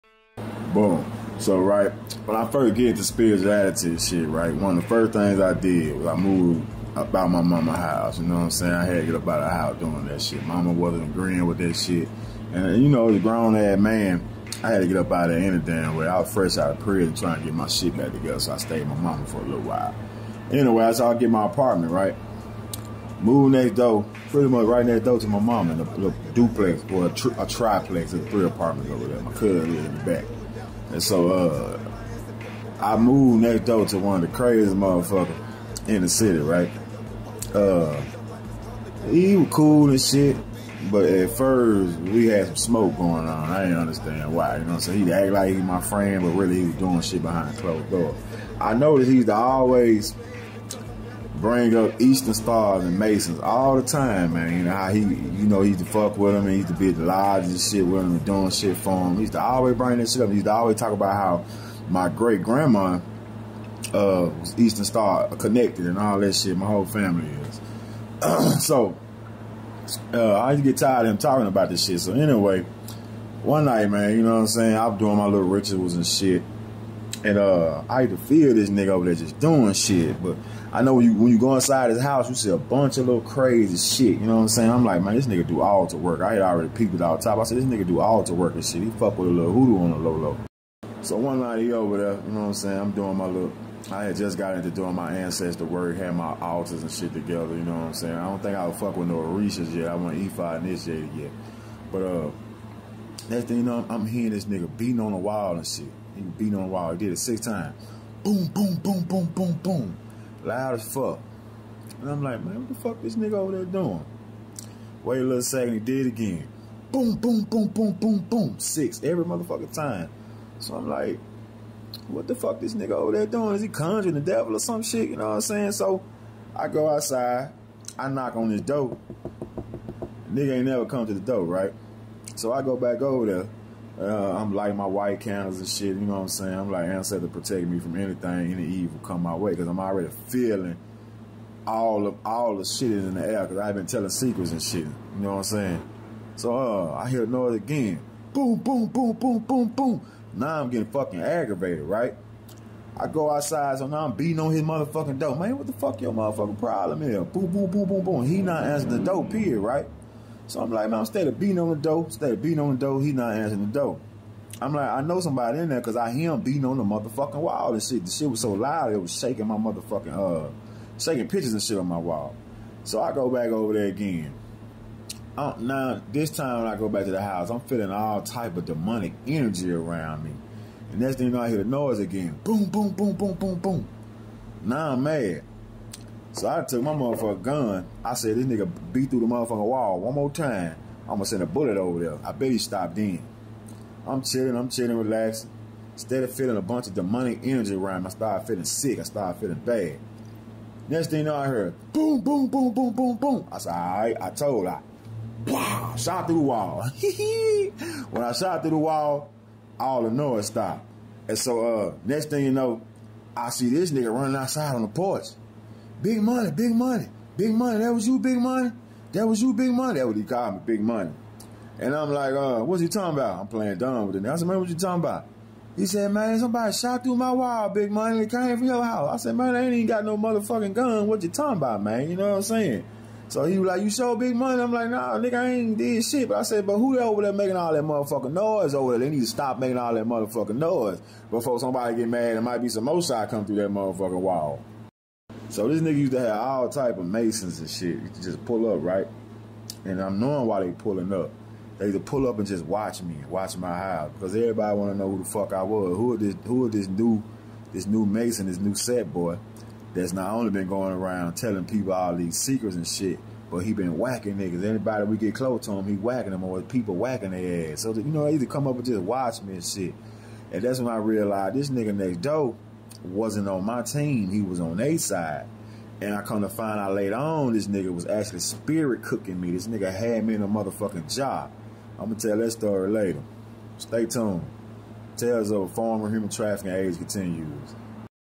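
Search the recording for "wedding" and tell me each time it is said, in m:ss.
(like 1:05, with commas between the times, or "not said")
not said.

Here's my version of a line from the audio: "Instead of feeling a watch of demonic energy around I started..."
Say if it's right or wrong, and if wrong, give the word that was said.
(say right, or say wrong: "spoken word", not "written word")
wrong: "bunch", not "watch".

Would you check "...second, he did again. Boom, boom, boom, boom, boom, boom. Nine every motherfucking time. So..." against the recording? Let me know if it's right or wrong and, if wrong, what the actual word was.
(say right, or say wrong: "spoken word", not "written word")
wrong: "Six", not "Nine".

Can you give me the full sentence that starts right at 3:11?
I'm gonna send a bullet over there.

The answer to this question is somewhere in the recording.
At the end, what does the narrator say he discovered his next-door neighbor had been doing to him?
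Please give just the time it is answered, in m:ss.
4:38.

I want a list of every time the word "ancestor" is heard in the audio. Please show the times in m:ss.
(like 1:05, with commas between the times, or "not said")
1:35, 2:16.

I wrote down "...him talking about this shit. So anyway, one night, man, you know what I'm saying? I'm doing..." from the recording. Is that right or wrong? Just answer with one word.
right.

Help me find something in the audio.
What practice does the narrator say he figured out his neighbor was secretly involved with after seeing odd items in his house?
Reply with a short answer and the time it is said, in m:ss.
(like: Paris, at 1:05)
hoodoo, at 1:29.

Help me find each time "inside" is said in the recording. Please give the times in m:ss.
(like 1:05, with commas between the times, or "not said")
1:21.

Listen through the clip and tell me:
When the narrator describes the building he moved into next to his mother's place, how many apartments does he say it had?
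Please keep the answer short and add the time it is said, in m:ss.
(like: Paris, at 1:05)
3, at 0:28.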